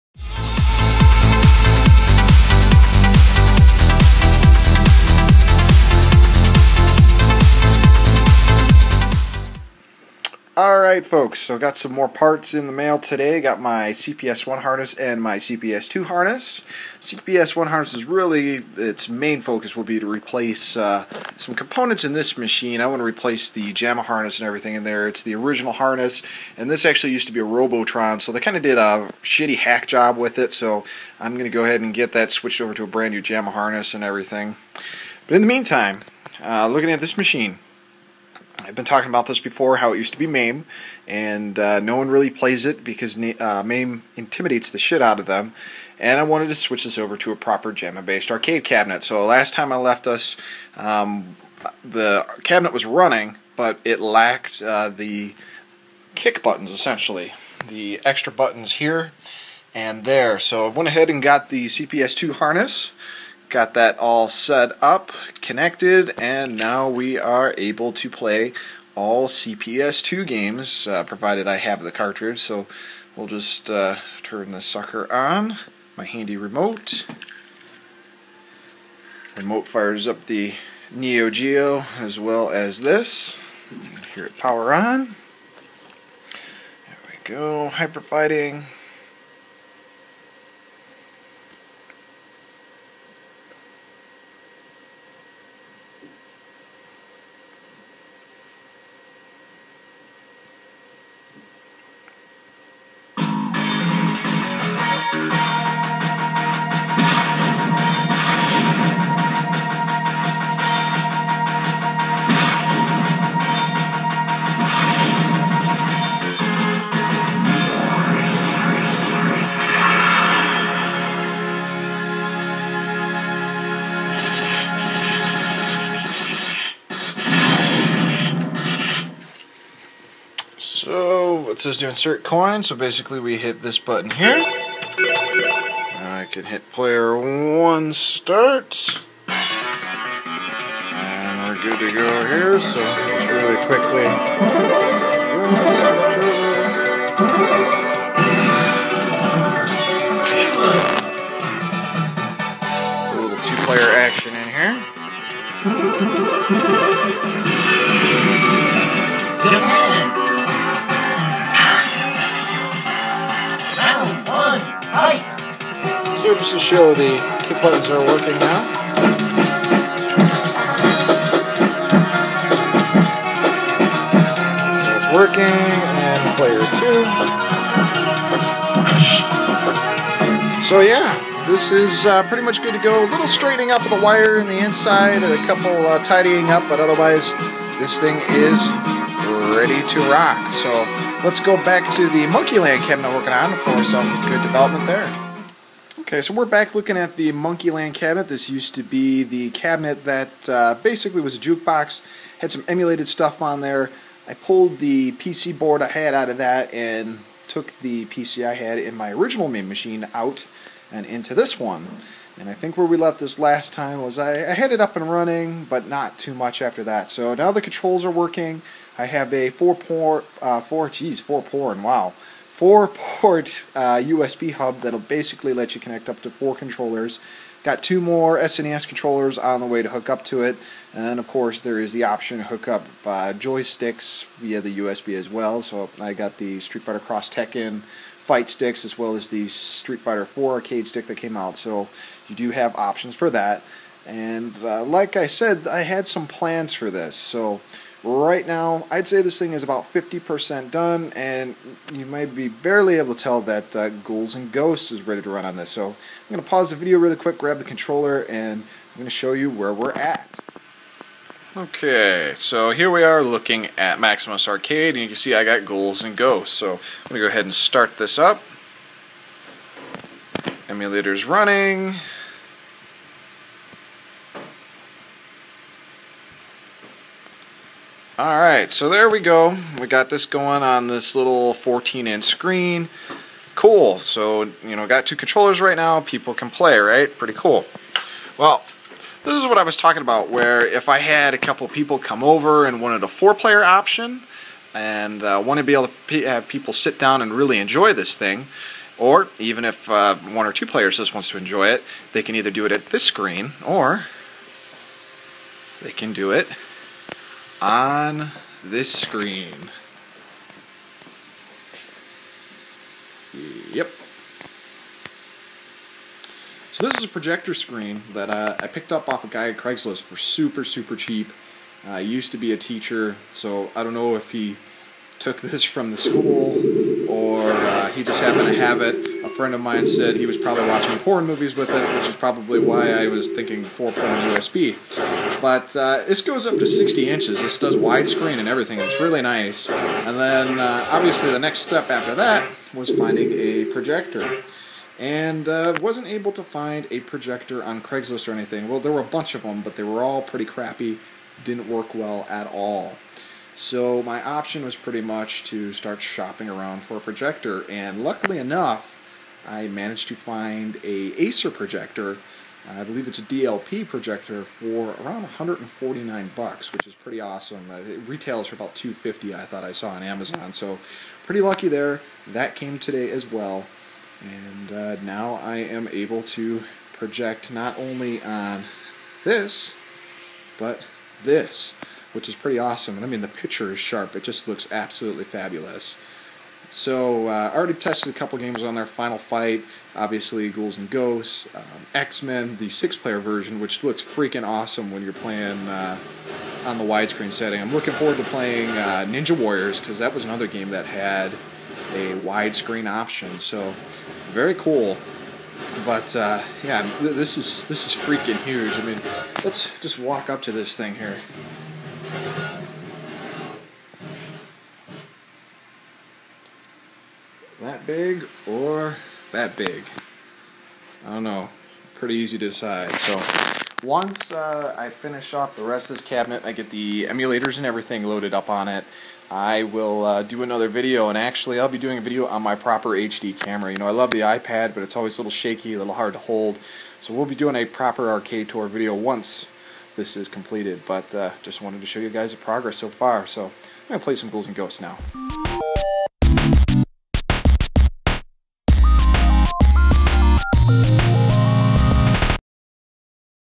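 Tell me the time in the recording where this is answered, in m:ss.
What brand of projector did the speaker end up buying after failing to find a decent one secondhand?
6:01.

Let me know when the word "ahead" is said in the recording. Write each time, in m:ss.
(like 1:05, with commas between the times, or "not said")
0:31, 1:00, 4:27.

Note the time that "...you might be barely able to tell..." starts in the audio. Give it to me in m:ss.
4:11.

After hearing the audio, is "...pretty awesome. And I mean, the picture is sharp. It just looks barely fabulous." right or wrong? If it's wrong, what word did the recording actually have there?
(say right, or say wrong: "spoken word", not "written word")
wrong: "absolutely", not "barely".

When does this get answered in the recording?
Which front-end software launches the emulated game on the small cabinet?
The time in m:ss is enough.
4:23.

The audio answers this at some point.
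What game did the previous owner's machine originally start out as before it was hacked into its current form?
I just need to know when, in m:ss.
0:27.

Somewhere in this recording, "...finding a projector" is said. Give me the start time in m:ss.
5:42.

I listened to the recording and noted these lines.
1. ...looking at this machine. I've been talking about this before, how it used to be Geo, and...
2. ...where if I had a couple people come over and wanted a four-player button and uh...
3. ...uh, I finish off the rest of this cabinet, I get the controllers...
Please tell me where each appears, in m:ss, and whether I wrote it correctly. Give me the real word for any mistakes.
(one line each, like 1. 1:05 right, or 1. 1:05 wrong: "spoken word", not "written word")
1. 0:36 wrong: "MAME", not "Geo"
2. 4:50 wrong: "option", not "button"
3. 7:04 wrong: "emulators", not "controllers".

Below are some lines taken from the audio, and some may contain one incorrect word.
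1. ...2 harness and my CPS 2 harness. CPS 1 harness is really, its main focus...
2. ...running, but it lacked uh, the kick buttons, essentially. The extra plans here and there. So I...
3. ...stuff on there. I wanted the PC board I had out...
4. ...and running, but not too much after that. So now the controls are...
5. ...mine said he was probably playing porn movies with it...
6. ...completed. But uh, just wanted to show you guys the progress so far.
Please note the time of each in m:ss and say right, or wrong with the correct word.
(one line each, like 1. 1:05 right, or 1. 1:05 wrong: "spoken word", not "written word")
1. 0:14 wrong: "1", not "2"
2. 0:52 wrong: "buttons", not "plans"
3. 3:23 wrong: "pulled", not "wanted"
4. 3:34 right
5. 5:29 wrong: "watching", not "playing"
6. 7:20 right.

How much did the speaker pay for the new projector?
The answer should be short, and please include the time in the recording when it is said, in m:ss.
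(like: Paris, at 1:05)
$149, at 6:05.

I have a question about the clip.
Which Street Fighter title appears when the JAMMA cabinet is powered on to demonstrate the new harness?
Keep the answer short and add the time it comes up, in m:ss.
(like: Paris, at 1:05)
Hyper fighting, at 1:27.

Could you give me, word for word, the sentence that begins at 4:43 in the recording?
So, you know, got two controllers right now.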